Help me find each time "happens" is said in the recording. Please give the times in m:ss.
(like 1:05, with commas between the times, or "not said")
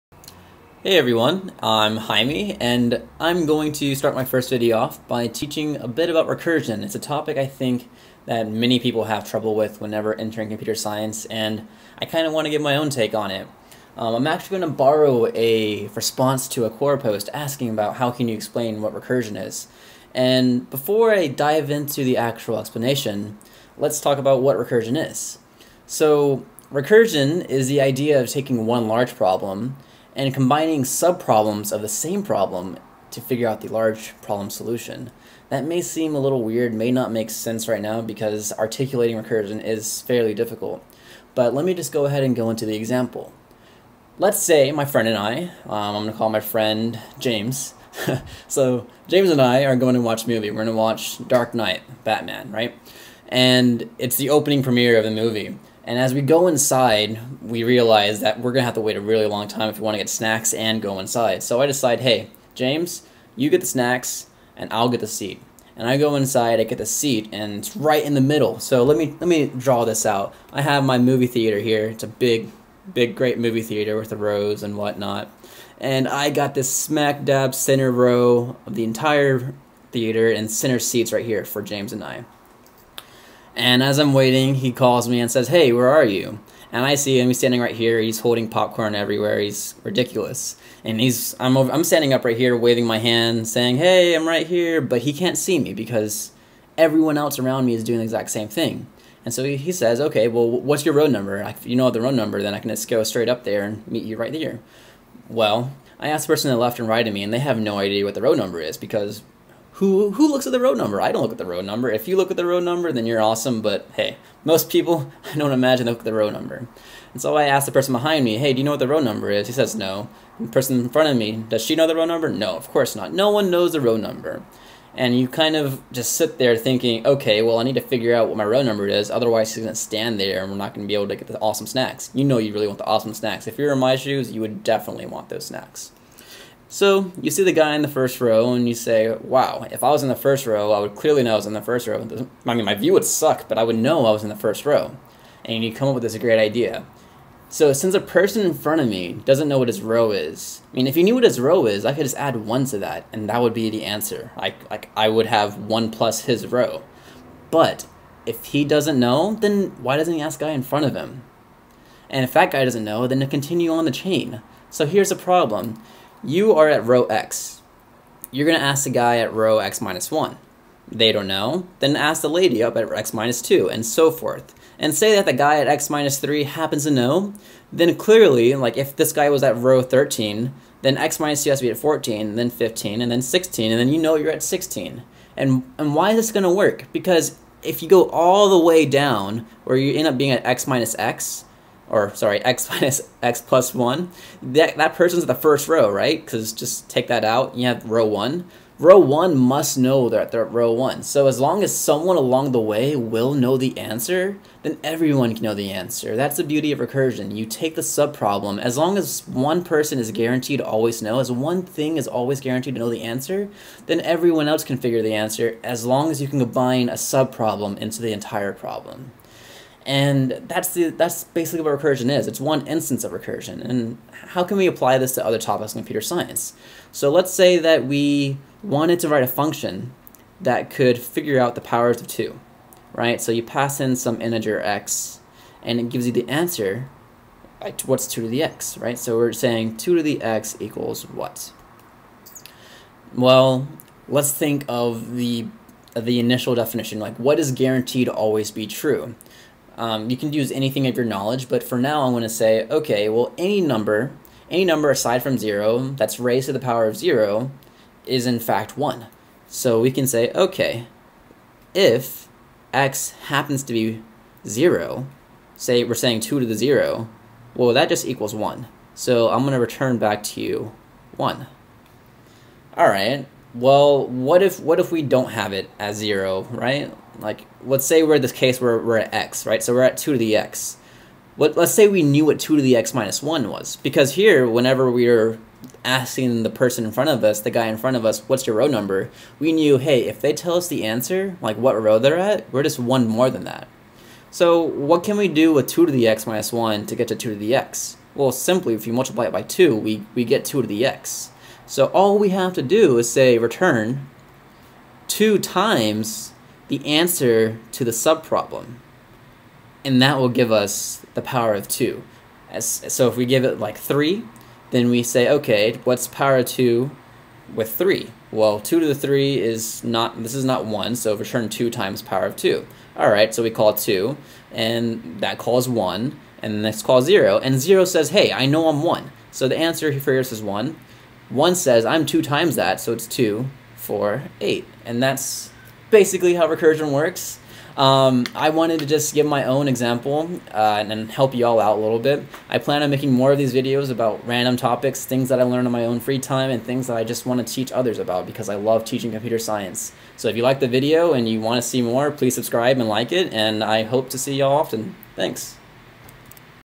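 2:56, 4:23.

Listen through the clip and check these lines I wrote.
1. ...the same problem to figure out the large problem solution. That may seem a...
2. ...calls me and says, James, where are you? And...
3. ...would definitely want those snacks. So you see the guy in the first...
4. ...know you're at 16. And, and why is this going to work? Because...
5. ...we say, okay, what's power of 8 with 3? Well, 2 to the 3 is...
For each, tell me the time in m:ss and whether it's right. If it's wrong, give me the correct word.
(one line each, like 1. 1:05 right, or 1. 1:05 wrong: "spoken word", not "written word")
1. 0:31 right
2. 1:24 wrong: "Hey", not "James"
3. 2:14 right
4. 3:03 right
5. 5:14 wrong: "2", not "8".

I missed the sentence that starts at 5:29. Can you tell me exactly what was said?
So the answer for yours is 1.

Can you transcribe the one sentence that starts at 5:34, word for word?
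And that's basically how recursion works.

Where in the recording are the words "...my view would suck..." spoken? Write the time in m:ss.
2:22.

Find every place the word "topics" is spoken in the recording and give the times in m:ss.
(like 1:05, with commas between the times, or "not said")
0:06, 3:45, 5:44.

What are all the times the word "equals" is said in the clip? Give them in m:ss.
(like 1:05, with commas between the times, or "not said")
4:00, 4:28.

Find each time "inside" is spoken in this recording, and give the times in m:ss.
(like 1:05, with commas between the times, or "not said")
0:56, 1:00, 1:06.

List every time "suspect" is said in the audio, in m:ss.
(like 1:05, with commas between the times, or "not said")
not said.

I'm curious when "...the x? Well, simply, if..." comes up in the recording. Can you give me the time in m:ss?
4:57.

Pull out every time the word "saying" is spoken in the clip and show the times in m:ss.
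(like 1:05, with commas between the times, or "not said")
1:33, 3:59, 4:25.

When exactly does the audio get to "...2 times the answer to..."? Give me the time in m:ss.
5:05.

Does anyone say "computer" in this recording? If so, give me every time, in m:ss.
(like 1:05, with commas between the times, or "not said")
0:10, 3:45, 5:49.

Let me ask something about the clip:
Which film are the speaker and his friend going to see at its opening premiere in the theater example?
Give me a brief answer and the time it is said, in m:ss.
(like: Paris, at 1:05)
Dark Knight, at 0:51.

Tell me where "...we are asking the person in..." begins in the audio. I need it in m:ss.
4:44.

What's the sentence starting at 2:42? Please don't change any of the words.
And if that guy doesn't know, then to continue on the chain.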